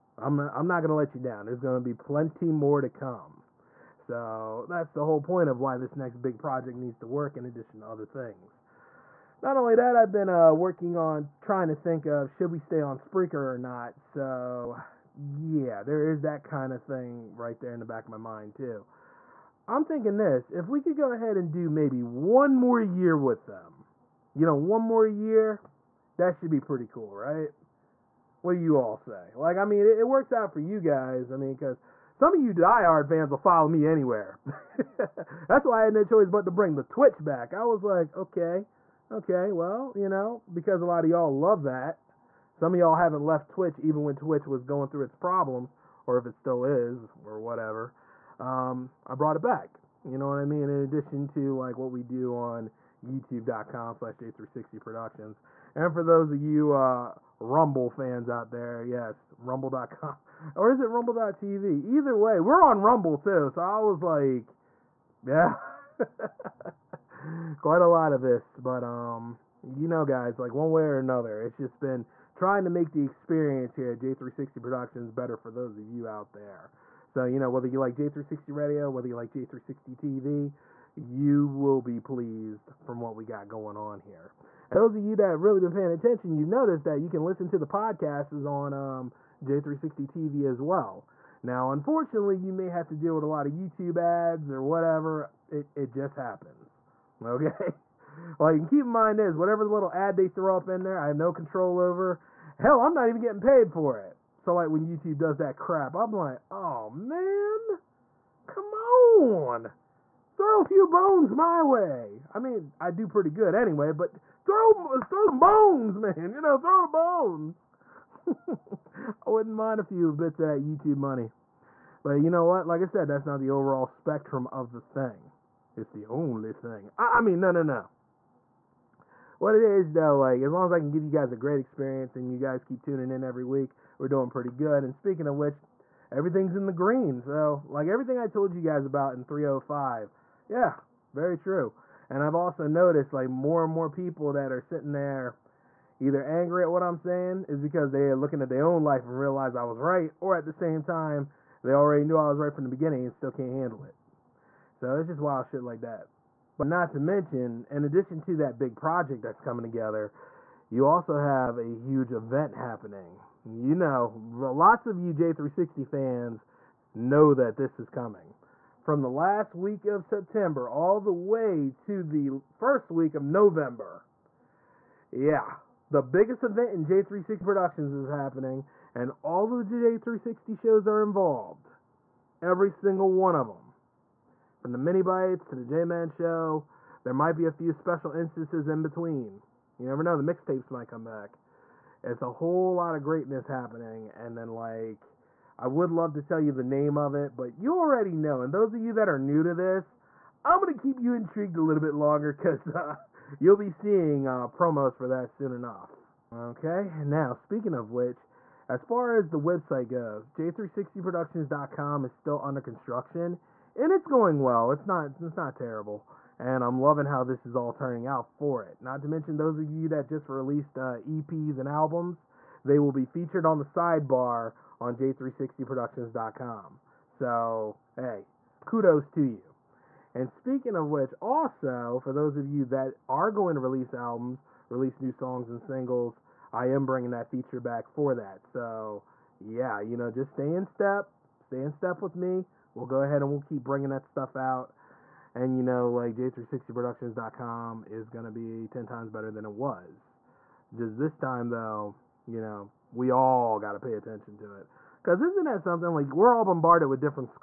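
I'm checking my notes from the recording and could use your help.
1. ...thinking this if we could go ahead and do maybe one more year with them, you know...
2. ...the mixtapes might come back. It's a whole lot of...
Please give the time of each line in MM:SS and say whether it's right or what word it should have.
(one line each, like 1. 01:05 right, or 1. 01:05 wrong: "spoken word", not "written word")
1. 00:19 right
2. 03:10 right.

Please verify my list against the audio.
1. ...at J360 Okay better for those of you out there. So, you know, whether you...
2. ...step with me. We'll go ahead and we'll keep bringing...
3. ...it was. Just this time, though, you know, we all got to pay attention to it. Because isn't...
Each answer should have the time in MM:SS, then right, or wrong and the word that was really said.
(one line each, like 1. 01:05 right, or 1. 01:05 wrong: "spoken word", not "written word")
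1. 01:13 wrong: "Productions", not "Okay"
2. 04:01 right
3. 04:09 right.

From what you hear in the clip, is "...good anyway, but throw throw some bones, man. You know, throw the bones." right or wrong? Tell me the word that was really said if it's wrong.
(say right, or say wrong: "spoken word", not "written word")
right.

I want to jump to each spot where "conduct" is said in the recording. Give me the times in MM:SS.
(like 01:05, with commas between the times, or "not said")
not said.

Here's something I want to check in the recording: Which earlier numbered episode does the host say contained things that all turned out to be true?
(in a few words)
305.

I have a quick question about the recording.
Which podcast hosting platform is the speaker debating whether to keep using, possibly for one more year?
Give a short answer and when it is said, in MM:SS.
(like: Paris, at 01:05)
Spreaker, at 00:12.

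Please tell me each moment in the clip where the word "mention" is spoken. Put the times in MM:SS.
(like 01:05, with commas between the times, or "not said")
02:36, 03:39.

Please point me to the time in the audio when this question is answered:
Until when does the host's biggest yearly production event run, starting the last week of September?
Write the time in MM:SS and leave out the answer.
02:52.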